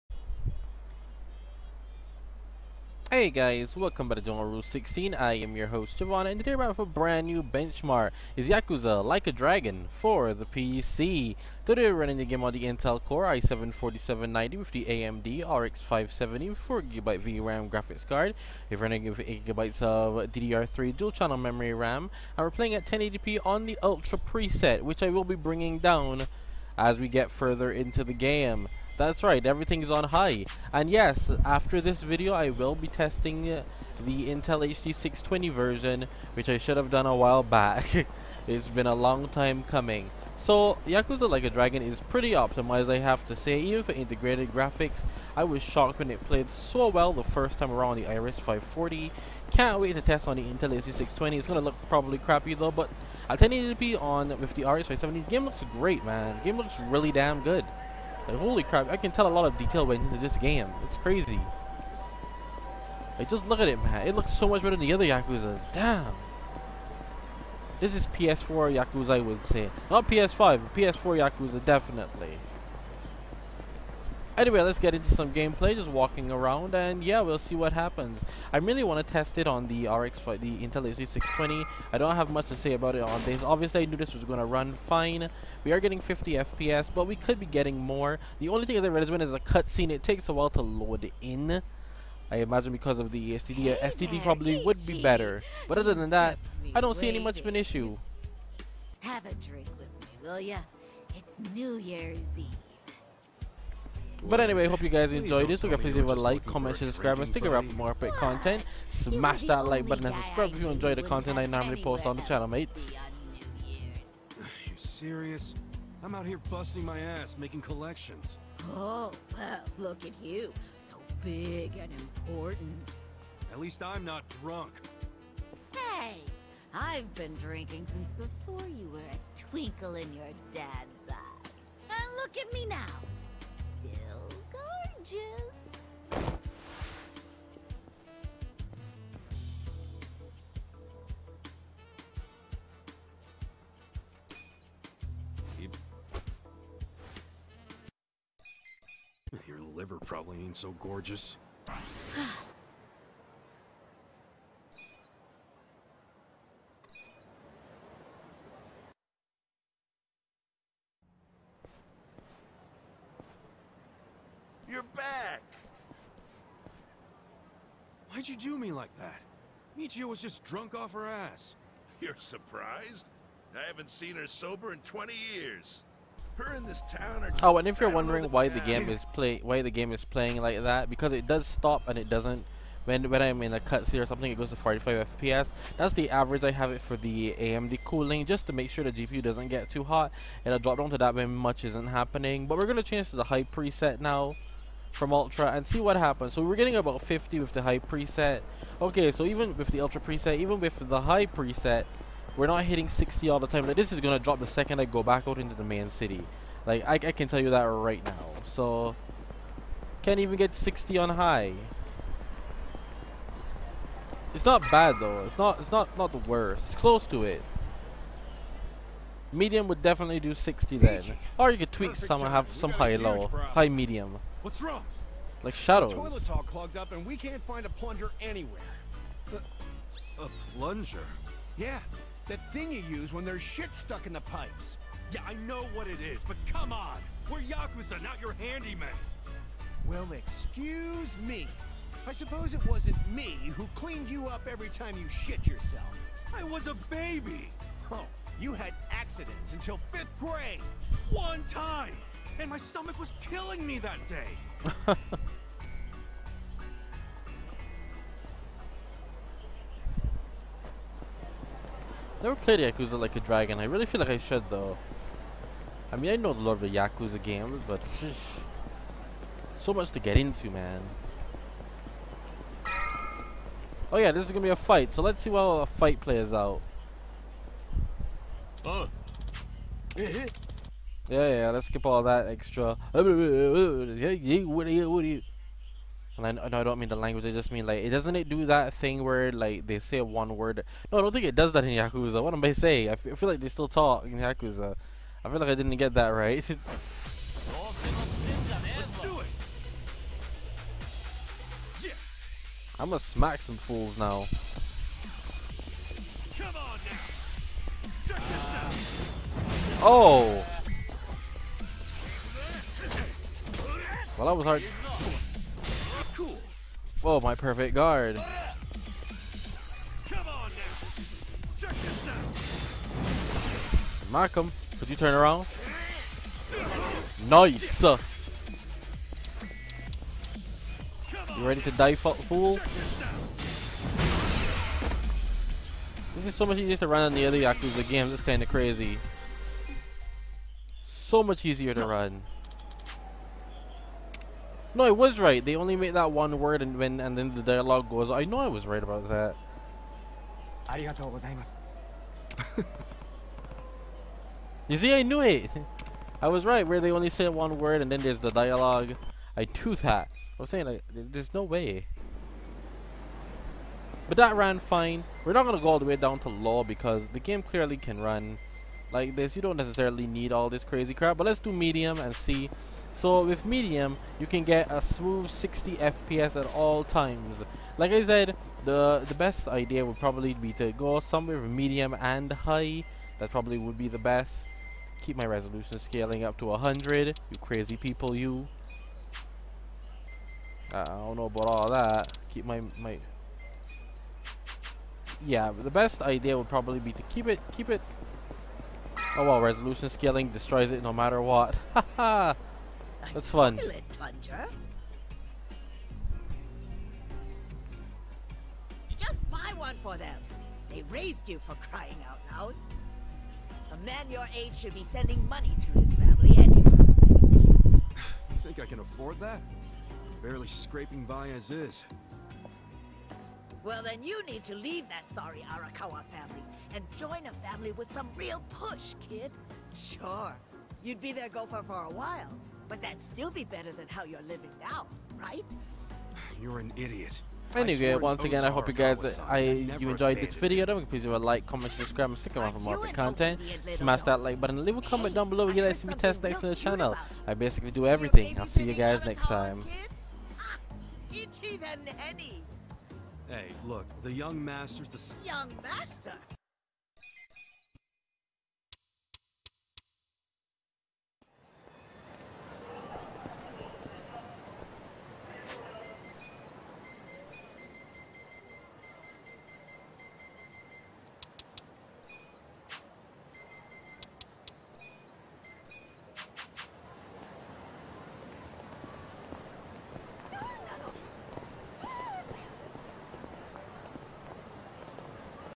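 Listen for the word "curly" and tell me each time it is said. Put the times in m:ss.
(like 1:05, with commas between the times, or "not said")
not said.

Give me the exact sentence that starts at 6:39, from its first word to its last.
Oh well, resolution scaling destroys it no matter what.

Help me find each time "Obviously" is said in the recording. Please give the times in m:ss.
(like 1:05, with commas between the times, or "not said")
1:23.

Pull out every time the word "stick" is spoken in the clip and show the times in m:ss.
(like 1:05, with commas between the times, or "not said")
1:47, 7:22.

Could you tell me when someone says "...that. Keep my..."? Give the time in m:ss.
6:31.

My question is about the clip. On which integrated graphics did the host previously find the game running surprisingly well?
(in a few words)
Iris 540.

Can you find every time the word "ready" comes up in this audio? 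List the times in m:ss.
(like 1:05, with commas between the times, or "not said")
5:31.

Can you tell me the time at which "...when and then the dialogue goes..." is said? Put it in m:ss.
5:46.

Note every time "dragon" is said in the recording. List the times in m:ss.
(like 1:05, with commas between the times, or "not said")
0:09, 0:41, 4:23.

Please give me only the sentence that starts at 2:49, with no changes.
Michio was just drunk off her ass.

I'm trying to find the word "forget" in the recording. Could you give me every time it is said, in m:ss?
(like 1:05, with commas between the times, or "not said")
7:20.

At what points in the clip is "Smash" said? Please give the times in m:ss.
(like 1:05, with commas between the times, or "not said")
1:48, 7:23.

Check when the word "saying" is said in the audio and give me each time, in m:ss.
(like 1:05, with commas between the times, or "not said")
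4:52, 6:00.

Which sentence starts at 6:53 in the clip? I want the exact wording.
A man your age should be sending money to his family anyway.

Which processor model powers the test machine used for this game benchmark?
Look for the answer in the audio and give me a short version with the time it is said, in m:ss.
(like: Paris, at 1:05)
Intel Core i7-4790, at 0:12.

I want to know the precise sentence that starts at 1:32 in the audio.
I imagine because of the SSD, hey SSD there, probably would be better.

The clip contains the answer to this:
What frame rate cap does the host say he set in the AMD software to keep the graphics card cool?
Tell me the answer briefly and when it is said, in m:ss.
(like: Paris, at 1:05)
45 FPS, at 3:04.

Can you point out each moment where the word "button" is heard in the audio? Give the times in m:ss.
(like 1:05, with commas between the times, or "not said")
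1:49, 7:24.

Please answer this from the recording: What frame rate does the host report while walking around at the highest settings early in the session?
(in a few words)
50 FPS.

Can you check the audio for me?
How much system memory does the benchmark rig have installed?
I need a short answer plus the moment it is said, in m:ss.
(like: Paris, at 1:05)
8GB, at 0:19.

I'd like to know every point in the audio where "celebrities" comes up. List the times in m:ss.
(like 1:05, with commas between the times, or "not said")
not said.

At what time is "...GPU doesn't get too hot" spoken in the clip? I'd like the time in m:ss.
3:08.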